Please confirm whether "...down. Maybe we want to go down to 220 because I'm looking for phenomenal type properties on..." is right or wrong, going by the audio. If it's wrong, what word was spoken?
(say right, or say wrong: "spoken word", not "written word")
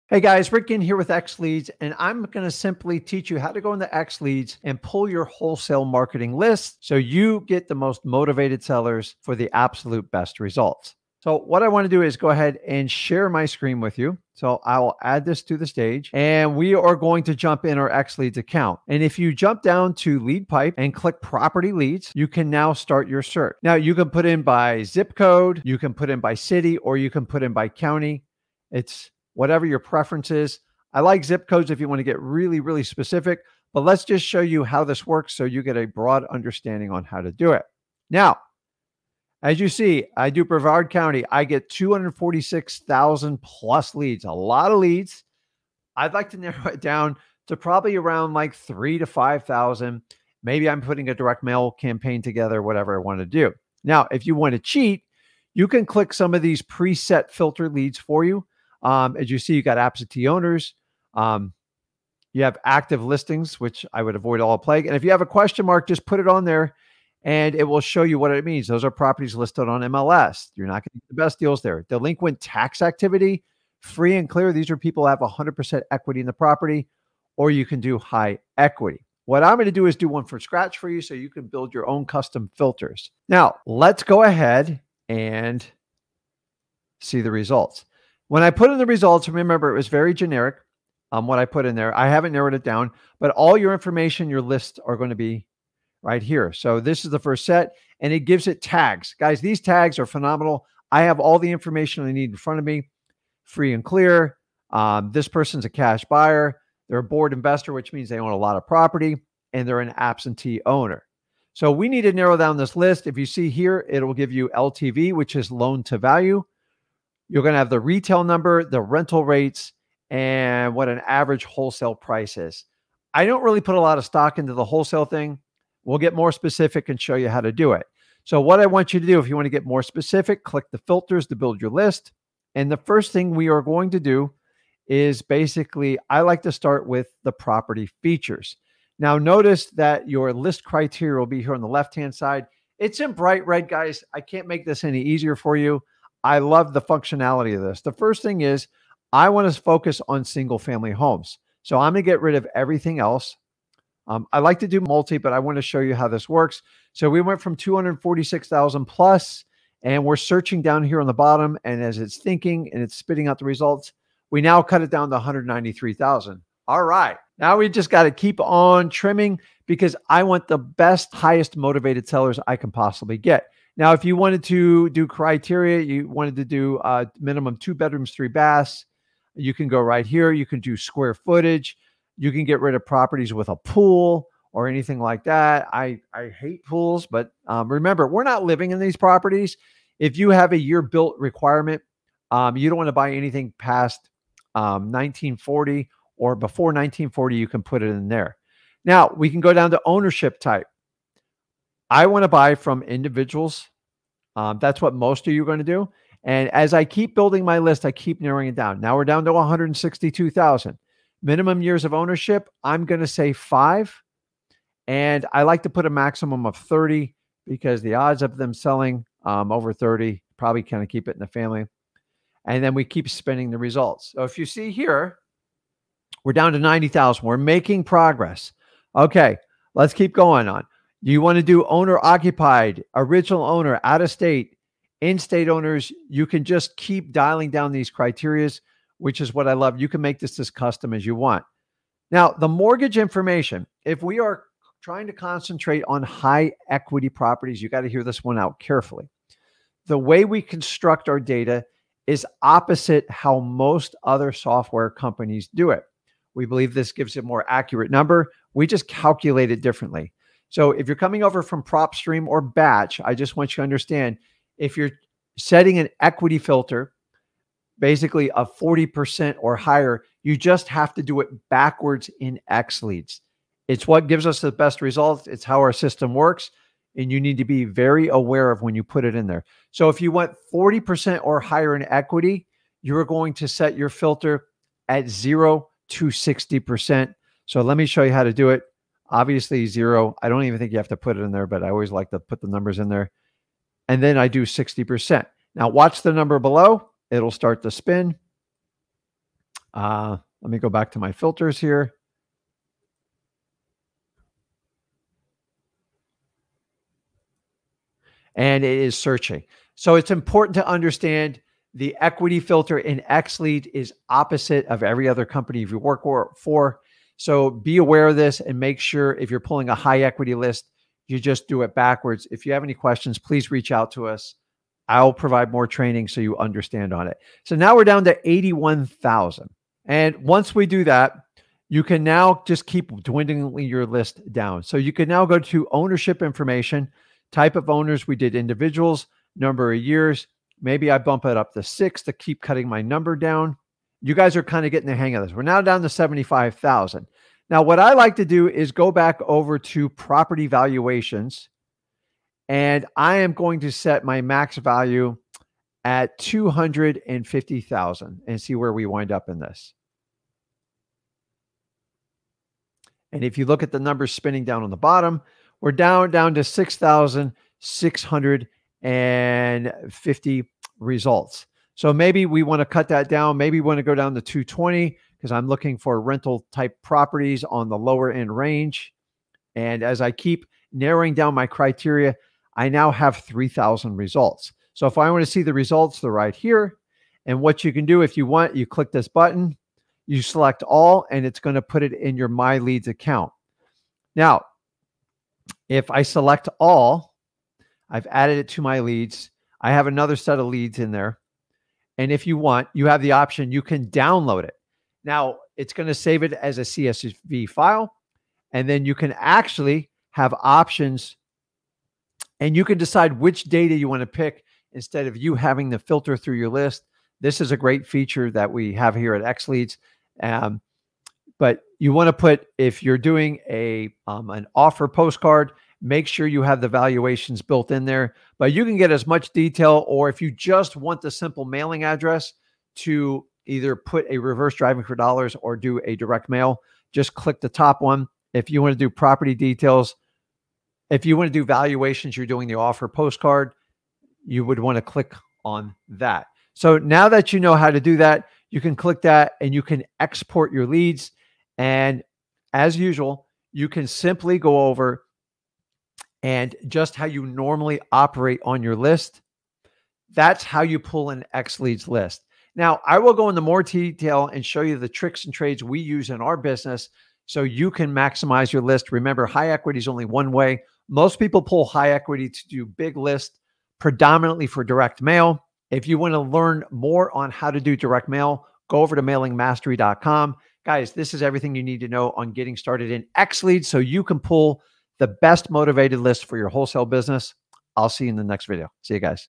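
wrong: "rental", not "phenomenal".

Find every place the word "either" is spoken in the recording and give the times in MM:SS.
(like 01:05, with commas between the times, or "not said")
07:13.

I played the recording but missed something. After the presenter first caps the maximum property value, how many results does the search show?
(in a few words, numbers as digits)
6,650.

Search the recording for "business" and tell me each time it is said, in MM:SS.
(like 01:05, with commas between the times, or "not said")
07:46, 08:06.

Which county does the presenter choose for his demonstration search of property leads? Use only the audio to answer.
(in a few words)
Brevard County.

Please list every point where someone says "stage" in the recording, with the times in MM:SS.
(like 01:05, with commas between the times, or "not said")
00:15.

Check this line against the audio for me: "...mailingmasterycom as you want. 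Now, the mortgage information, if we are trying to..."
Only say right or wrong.
wrong.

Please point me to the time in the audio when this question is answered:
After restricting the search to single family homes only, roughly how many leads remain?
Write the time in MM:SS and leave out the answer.
02:45.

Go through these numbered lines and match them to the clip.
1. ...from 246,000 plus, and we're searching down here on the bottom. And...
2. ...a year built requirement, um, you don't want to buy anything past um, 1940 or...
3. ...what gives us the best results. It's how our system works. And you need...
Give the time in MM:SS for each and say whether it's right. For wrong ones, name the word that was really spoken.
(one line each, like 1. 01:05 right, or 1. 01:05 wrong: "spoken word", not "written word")
1. 02:37 right
2. 03:10 right
3. 04:33 right.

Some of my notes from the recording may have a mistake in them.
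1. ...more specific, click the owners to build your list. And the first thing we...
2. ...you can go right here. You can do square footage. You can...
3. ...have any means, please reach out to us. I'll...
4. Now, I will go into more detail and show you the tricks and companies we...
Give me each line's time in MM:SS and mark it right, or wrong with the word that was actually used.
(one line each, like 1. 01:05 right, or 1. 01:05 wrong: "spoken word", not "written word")
1. 02:09 wrong: "filters", not "owners"
2. 02:59 right
3. 05:22 wrong: "questions", not "means"
4. 07:42 wrong: "trades", not "companies".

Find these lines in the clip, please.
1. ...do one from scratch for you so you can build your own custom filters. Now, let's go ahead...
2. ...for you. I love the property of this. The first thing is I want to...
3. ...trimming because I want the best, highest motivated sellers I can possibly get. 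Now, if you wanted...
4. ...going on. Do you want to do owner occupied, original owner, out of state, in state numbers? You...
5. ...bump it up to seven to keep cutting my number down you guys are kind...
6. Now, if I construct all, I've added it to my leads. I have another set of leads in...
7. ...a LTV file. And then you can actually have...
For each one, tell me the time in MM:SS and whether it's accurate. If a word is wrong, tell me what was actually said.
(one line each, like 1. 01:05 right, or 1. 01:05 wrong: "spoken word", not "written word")
1. 01:19 right
2. 02:25 wrong: "functionality", not "property"
3. 02:48 right
4. 03:50 wrong: "owners", not "numbers"
5. 05:40 wrong: "six", not "seven"
6. 06:34 wrong: "select", not "construct"
7. 06:46 wrong: "CSV", not "LTV".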